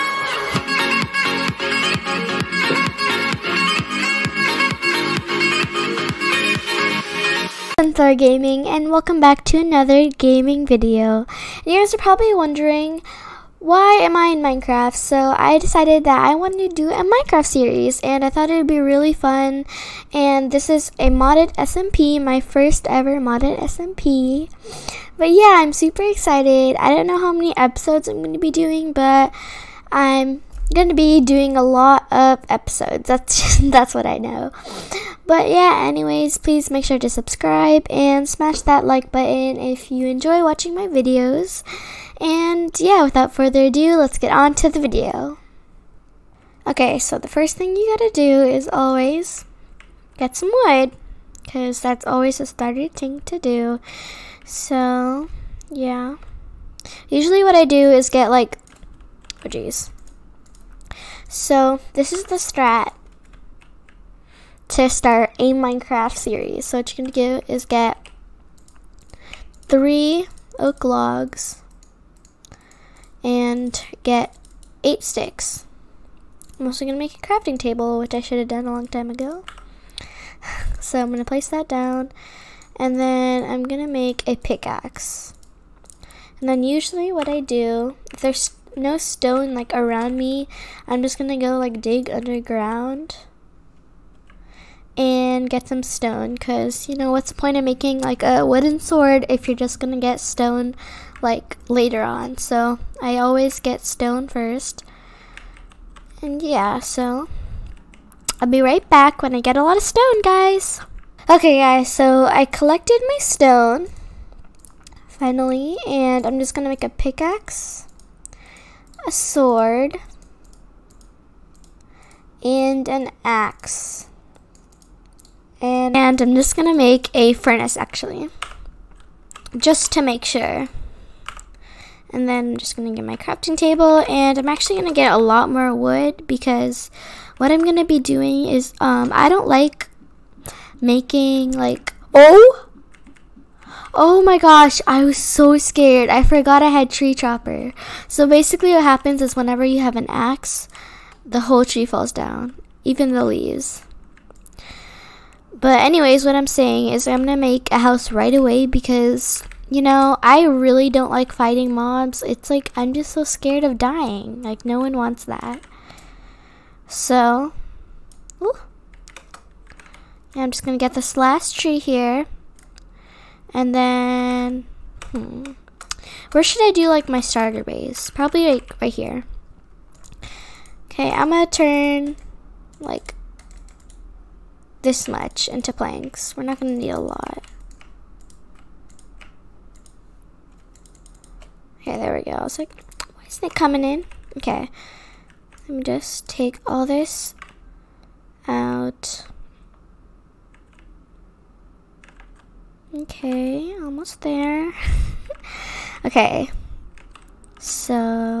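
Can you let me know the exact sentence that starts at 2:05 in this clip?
And, and I'm just gonna make a furnace actually, just to make sure.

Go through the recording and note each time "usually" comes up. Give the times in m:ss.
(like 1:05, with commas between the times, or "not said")
0:57, 1:26.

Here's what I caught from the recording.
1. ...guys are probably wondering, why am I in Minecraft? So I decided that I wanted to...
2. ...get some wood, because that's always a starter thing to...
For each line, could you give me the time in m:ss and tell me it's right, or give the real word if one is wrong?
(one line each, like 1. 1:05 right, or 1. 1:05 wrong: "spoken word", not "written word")
1. 0:11 right
2. 0:50 right.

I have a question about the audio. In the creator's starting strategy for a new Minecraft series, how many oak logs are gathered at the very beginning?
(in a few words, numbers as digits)
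3.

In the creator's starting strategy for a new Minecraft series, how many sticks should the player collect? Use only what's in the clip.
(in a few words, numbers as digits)
8.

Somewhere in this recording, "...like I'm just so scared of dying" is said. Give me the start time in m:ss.
2:42.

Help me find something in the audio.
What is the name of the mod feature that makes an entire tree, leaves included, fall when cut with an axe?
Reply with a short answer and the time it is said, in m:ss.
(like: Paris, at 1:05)
tree chopper, at 2:26.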